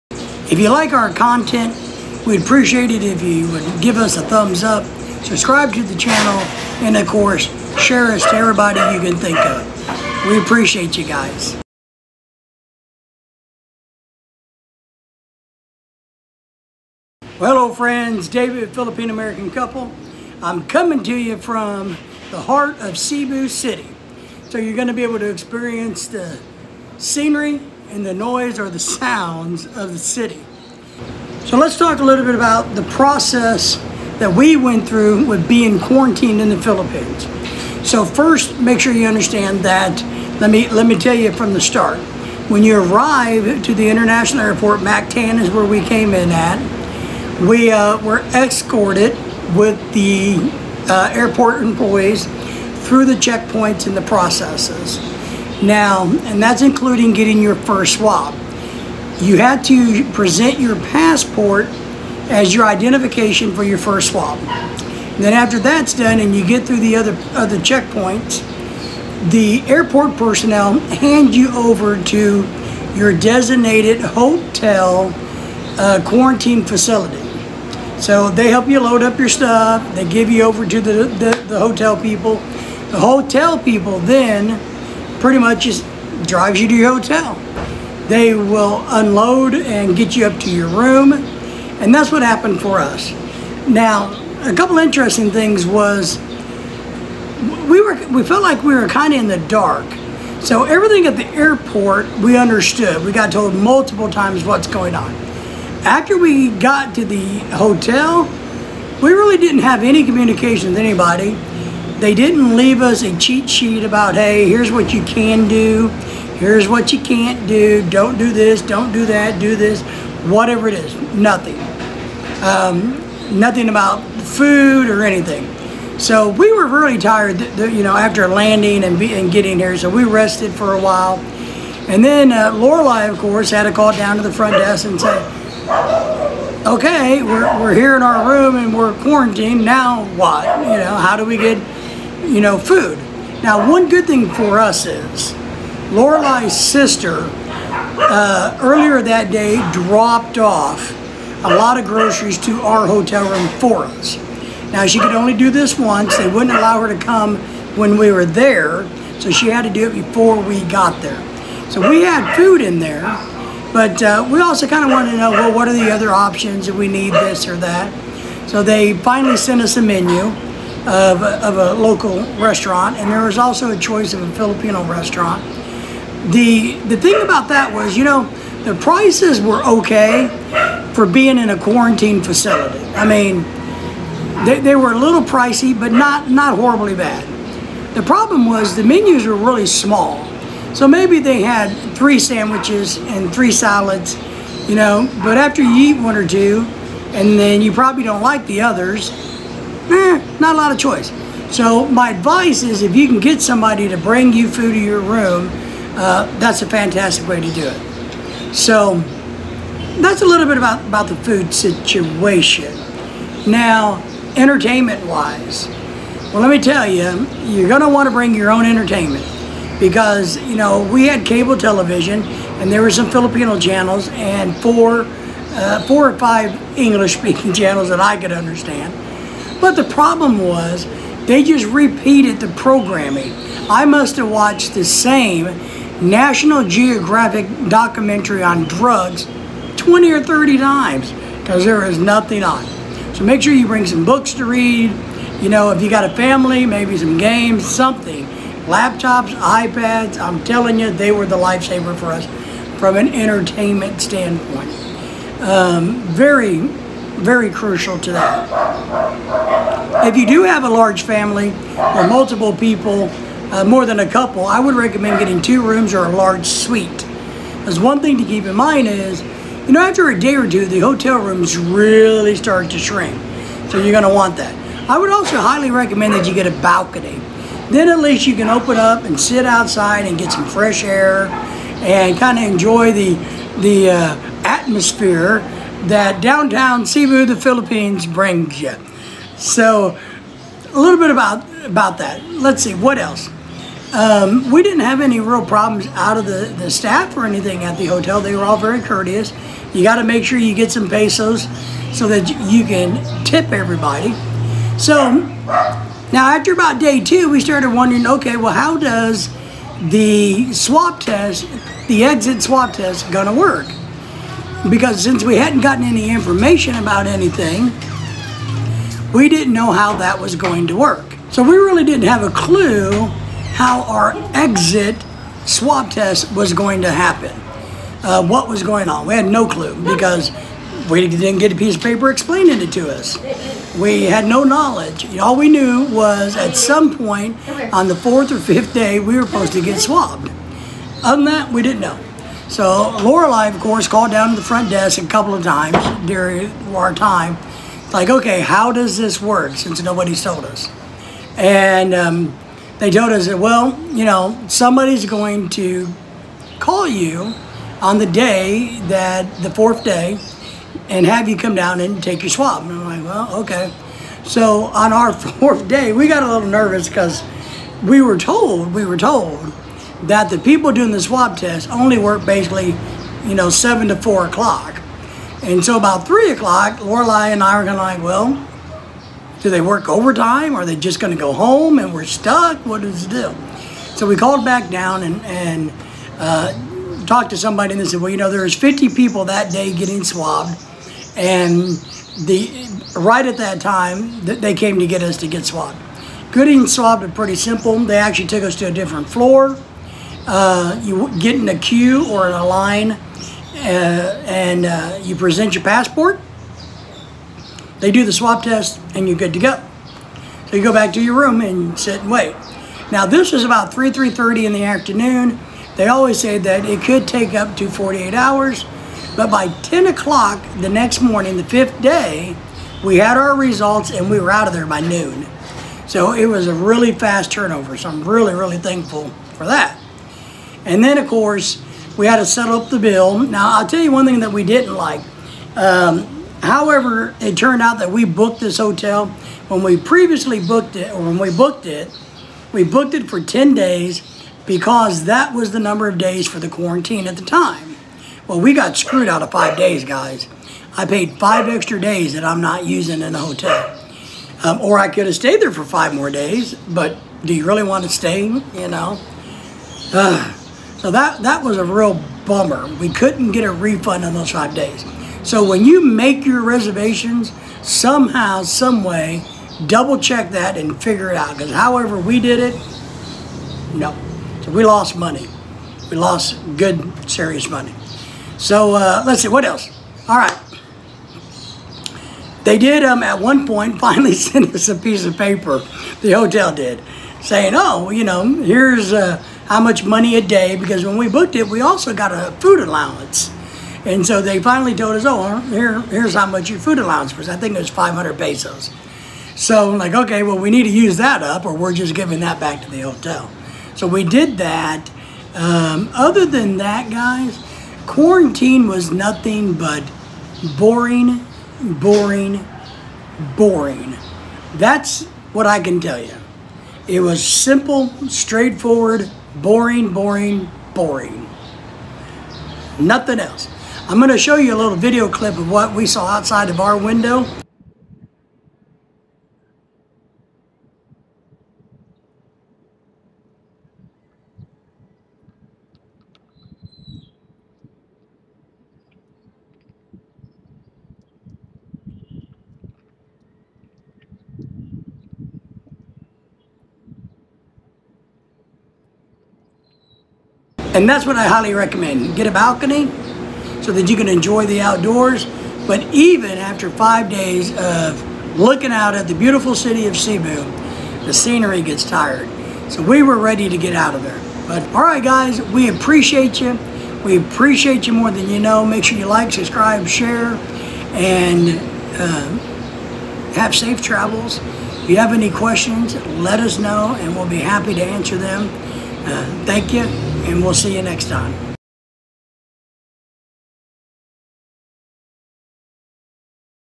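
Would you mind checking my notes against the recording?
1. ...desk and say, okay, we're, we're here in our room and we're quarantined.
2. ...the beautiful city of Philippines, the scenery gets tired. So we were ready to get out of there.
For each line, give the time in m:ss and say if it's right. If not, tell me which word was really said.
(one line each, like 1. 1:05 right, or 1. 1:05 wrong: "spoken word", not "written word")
1. 2:14 right
2. 9:19 wrong: "Cebu", not "Philippines".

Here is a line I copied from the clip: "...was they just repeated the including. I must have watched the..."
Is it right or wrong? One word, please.
wrong.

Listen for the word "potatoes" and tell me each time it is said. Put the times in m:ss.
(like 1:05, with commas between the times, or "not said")
not said.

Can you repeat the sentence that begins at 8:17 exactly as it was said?
I think it was 500 pesos.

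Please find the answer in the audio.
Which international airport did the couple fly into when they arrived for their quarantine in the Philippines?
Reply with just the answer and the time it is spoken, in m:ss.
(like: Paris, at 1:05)
Mactan, at 0:44.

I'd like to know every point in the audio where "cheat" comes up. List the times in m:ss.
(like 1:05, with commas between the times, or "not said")
1:53.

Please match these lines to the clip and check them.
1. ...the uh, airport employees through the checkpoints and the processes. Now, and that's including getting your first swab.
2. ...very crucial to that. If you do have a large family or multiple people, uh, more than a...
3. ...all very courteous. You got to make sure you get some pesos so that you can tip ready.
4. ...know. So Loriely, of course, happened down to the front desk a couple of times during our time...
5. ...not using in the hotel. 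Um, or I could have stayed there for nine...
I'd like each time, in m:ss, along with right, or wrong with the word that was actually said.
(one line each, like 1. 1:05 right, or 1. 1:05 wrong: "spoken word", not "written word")
1. 0:49 right
2. 4:17 right
3. 4:58 wrong: "everybody", not "ready"
4. 5:41 wrong: "called", not "happened"
5. 7:32 wrong: "five", not "nine".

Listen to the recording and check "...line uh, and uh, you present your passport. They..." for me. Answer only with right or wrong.
right.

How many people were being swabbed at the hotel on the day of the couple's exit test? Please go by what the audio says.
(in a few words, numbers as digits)
50.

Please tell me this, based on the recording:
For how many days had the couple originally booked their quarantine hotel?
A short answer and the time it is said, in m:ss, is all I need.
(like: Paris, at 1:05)
10, at 7:23.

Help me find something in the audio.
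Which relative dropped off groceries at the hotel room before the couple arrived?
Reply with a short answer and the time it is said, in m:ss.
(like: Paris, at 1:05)
Loriely's sister, at 2:25.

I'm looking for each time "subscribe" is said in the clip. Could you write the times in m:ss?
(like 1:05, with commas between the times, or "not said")
0:05, 9:29.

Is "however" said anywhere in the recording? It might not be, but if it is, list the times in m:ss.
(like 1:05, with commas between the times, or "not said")
7:16, 7:51.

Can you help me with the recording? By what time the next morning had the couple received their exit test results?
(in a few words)
10 o'clock.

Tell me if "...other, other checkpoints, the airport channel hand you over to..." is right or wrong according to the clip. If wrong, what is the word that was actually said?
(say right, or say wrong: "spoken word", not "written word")
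wrong: "personnel", not "channel".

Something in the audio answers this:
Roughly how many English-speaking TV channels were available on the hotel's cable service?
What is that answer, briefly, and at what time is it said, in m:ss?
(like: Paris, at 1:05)
4 or 5, at 3:45.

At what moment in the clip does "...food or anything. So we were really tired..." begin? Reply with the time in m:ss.
2:04.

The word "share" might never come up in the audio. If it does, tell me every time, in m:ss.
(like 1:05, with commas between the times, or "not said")
0:07, 9:29.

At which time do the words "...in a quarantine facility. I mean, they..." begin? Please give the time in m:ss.
3:01.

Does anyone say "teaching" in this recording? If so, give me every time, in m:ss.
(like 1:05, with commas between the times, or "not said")
not said.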